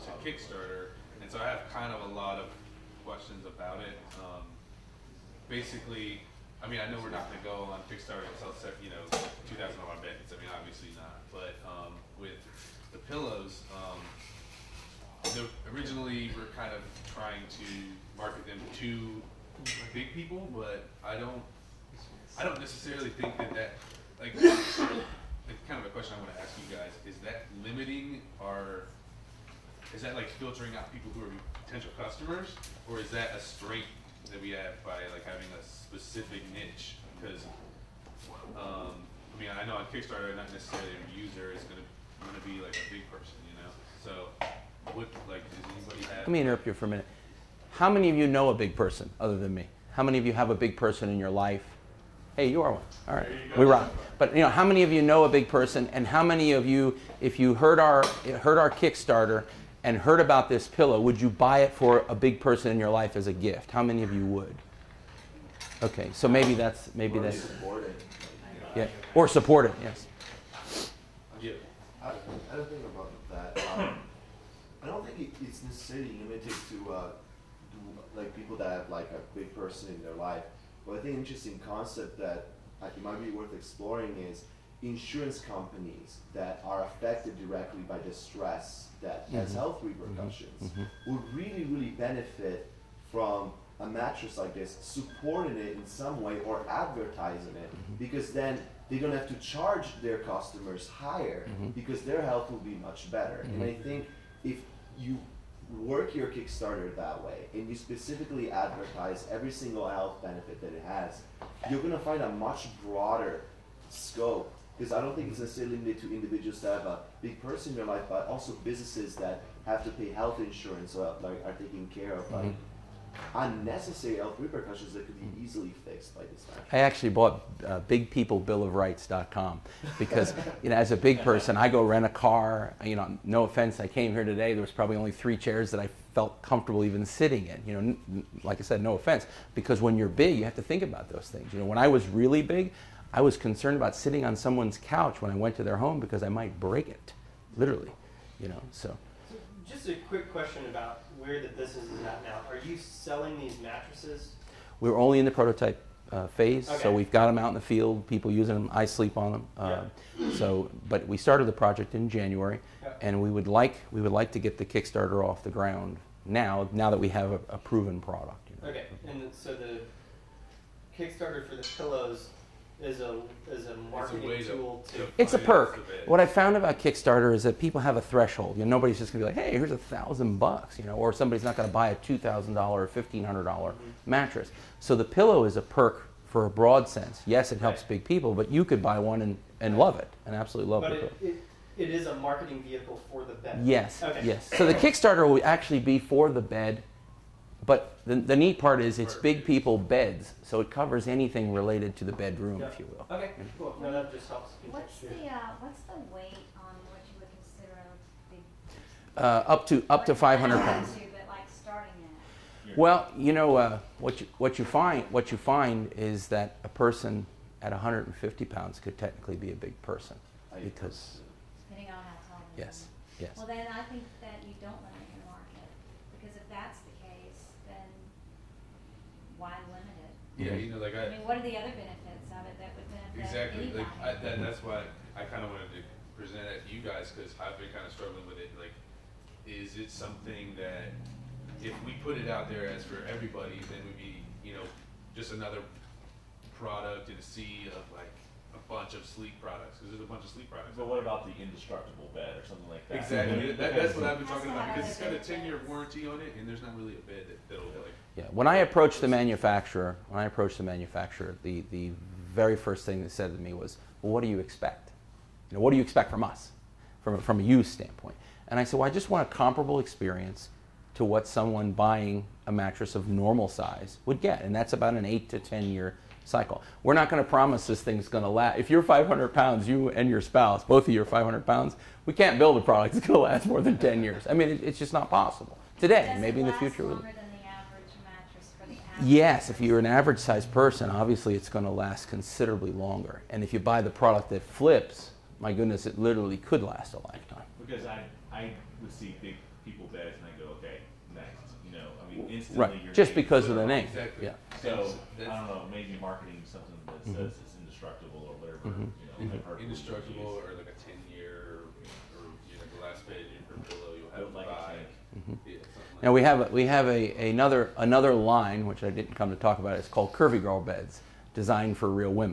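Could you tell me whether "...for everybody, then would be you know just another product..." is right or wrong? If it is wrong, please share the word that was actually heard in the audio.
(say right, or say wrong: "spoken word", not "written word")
right.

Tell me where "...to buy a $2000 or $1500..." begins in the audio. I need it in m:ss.
3:01.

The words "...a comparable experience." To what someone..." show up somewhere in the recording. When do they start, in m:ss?
4:29.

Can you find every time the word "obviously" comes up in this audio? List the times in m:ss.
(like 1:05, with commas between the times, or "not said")
0:10, 4:50.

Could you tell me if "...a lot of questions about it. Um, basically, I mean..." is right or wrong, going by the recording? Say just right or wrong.
right.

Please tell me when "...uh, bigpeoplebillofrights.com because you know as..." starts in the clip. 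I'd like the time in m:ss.
2:07.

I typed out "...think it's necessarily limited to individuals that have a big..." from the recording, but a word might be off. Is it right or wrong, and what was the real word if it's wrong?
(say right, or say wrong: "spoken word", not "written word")
right.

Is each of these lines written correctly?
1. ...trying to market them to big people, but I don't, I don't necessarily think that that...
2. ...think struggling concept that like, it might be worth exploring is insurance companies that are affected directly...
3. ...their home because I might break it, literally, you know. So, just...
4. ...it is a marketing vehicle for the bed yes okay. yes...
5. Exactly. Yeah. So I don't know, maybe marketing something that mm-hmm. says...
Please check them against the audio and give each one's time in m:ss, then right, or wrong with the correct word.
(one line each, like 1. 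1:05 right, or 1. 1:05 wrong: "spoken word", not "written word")
1. 0:17 right
2. 1:20 wrong: "interesting", not "struggling"
3. 2:25 right
4. 3:11 right
5. 5:03 right.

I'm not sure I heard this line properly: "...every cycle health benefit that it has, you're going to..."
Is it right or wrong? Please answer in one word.
wrong.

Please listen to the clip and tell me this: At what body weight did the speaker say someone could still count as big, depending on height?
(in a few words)
150 pounds.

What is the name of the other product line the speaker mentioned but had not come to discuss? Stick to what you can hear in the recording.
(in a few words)
Curvy Girl Beds.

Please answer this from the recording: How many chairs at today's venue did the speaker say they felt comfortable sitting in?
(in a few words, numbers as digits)
3.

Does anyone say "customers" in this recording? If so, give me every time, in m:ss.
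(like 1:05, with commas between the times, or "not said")
0:31, 1:40.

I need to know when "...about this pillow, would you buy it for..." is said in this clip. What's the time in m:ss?
1:00.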